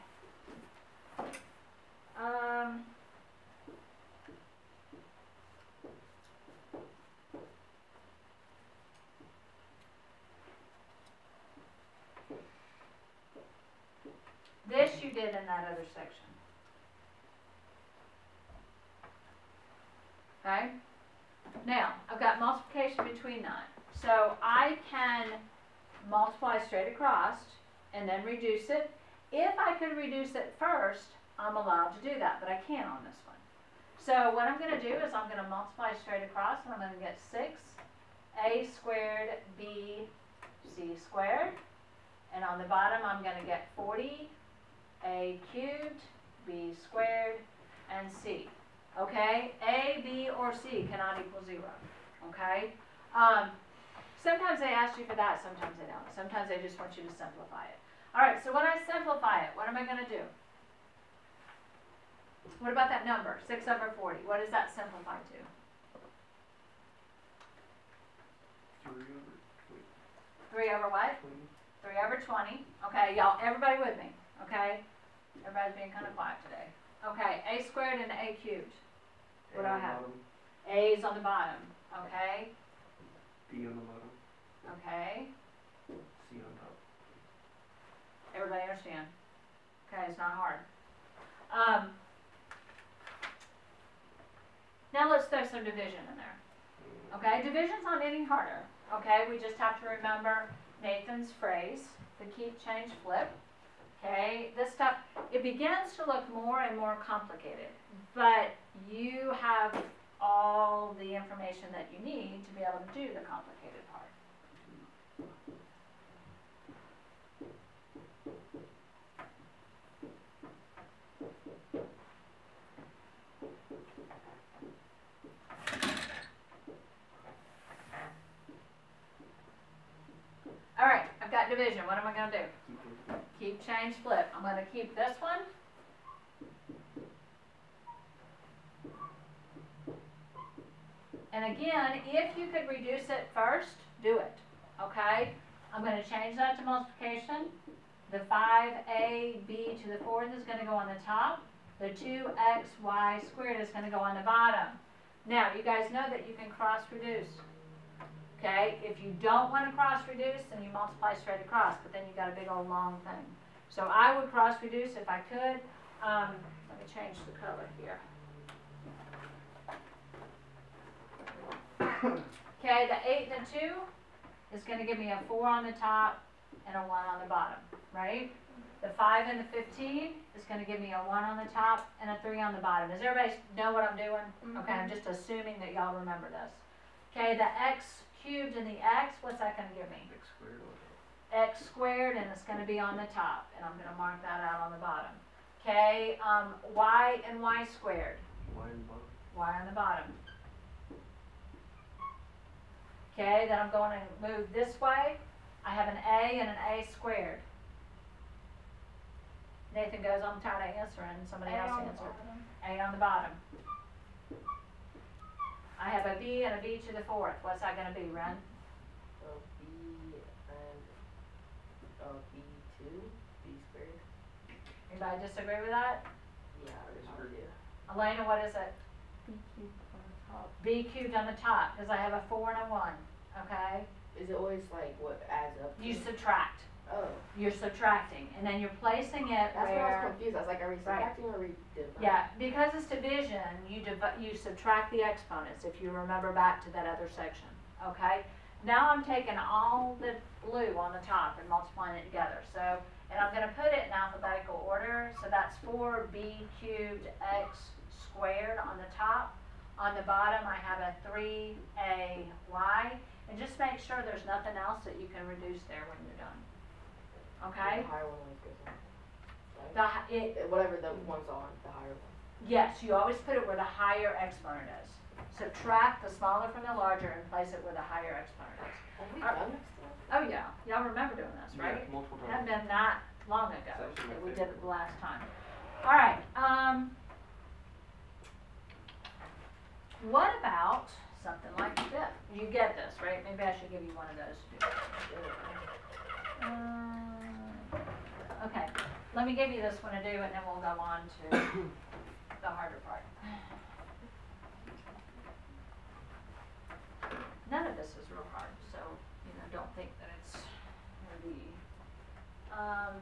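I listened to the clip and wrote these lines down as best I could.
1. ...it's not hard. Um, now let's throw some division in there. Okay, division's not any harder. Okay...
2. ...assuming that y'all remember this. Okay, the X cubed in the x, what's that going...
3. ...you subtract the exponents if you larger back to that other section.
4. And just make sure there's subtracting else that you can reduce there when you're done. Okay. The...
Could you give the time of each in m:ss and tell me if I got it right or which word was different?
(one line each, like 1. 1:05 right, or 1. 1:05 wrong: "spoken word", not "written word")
1. 1:30 right
2. 3:05 right
3. 4:04 wrong: "remember", not "larger"
4. 4:23 wrong: "nothing", not "subtracting".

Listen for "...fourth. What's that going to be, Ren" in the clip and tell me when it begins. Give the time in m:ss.
3:37.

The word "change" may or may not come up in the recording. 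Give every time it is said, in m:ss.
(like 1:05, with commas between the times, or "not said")
1:42, 2:13, 2:26, 2:46.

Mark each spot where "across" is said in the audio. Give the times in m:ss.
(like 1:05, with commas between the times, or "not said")
0:26, 0:36, 2:41.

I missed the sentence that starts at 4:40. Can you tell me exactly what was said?
Oh yeah, y'all remember doing this, right?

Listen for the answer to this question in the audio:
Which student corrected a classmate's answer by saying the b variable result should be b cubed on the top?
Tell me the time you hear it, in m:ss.
3:47.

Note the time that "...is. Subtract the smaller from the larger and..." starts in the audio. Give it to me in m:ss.
4:34.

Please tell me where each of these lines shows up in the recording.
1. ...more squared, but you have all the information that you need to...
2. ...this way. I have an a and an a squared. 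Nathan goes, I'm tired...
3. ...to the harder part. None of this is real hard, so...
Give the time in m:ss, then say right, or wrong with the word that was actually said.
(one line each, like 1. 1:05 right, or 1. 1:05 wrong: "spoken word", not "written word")
1. 1:46 wrong: "complicated", not "squared"
2. 3:24 right
3. 5:01 right.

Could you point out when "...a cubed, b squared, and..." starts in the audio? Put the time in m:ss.
0:45.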